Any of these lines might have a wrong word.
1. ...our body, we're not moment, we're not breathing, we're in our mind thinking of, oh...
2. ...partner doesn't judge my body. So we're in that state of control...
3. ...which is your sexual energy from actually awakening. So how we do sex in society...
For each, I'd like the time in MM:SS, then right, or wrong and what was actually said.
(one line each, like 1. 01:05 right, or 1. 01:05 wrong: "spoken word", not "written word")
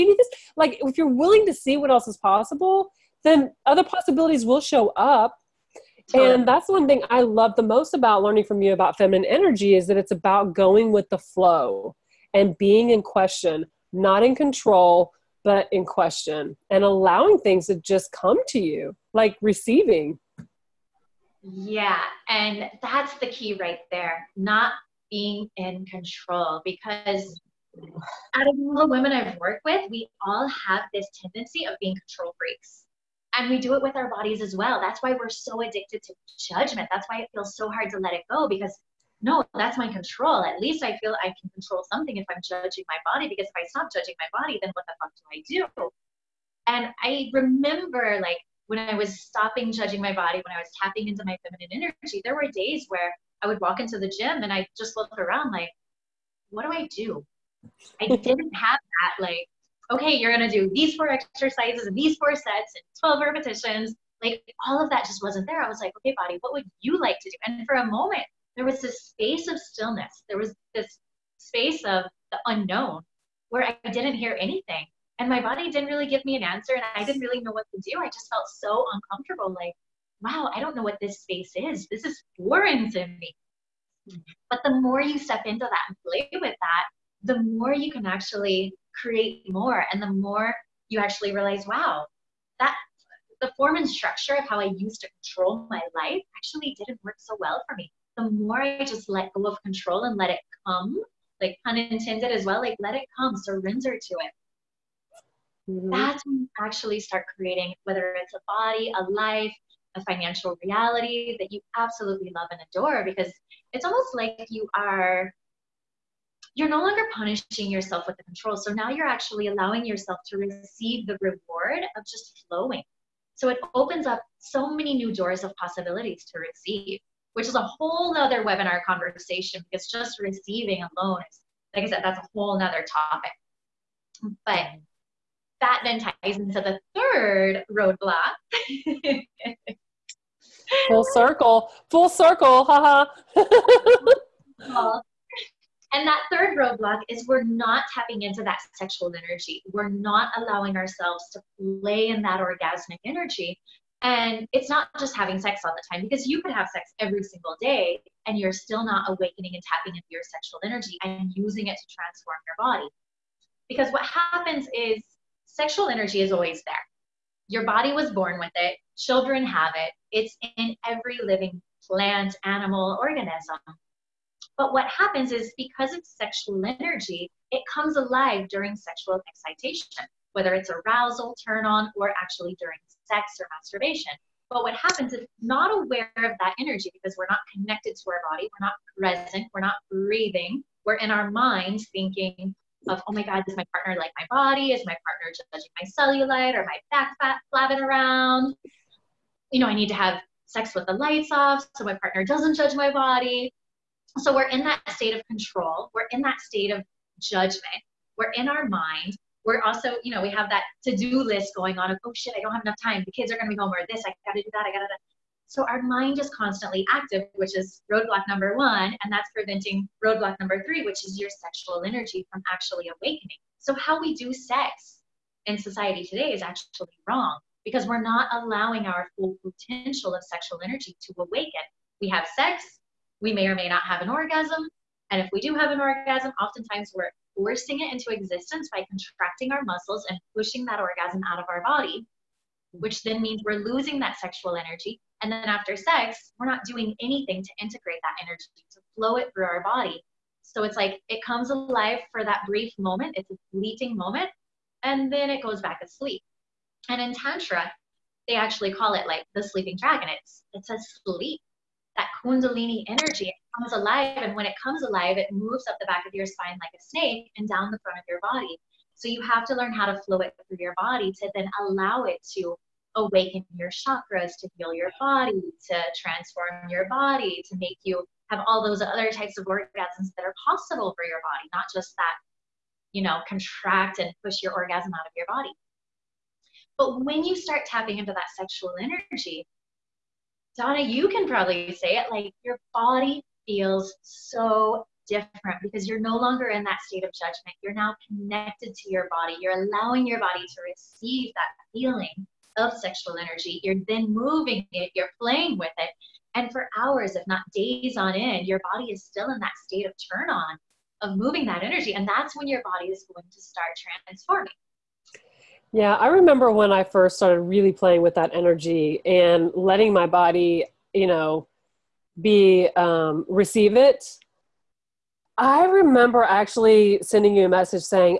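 1. 03:08 wrong: "present", not "moment"
2. 03:21 right
3. 03:40 right.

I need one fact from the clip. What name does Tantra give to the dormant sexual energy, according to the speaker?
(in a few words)
The sleeping dragon.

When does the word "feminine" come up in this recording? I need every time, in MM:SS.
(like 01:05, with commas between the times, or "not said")
00:08, 00:51.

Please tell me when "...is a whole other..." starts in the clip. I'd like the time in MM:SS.
02:07.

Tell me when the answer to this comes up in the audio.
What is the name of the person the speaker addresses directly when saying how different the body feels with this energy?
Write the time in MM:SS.
04:50.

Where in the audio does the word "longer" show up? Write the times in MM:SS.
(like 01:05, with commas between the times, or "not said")
01:56, 04:56.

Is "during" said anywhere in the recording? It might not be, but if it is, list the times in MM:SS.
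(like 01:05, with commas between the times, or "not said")
02:58, 03:02.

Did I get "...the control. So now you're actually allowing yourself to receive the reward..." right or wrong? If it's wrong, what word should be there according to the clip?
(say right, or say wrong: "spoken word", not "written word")
right.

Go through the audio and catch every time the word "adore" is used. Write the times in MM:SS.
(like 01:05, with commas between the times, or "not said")
01:52.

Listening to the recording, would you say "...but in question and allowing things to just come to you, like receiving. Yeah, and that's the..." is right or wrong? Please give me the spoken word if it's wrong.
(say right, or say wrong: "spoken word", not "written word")
right.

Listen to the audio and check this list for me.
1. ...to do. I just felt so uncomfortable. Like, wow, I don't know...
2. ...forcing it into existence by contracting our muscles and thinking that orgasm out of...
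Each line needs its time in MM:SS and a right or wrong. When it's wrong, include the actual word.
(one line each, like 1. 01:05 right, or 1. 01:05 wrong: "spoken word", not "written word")
1. 01:17 right
2. 03:57 wrong: "pushing", not "thinking".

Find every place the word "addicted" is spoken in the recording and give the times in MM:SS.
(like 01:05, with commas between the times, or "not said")
00:35.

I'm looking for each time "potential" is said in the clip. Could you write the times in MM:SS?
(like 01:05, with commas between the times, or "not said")
03:49.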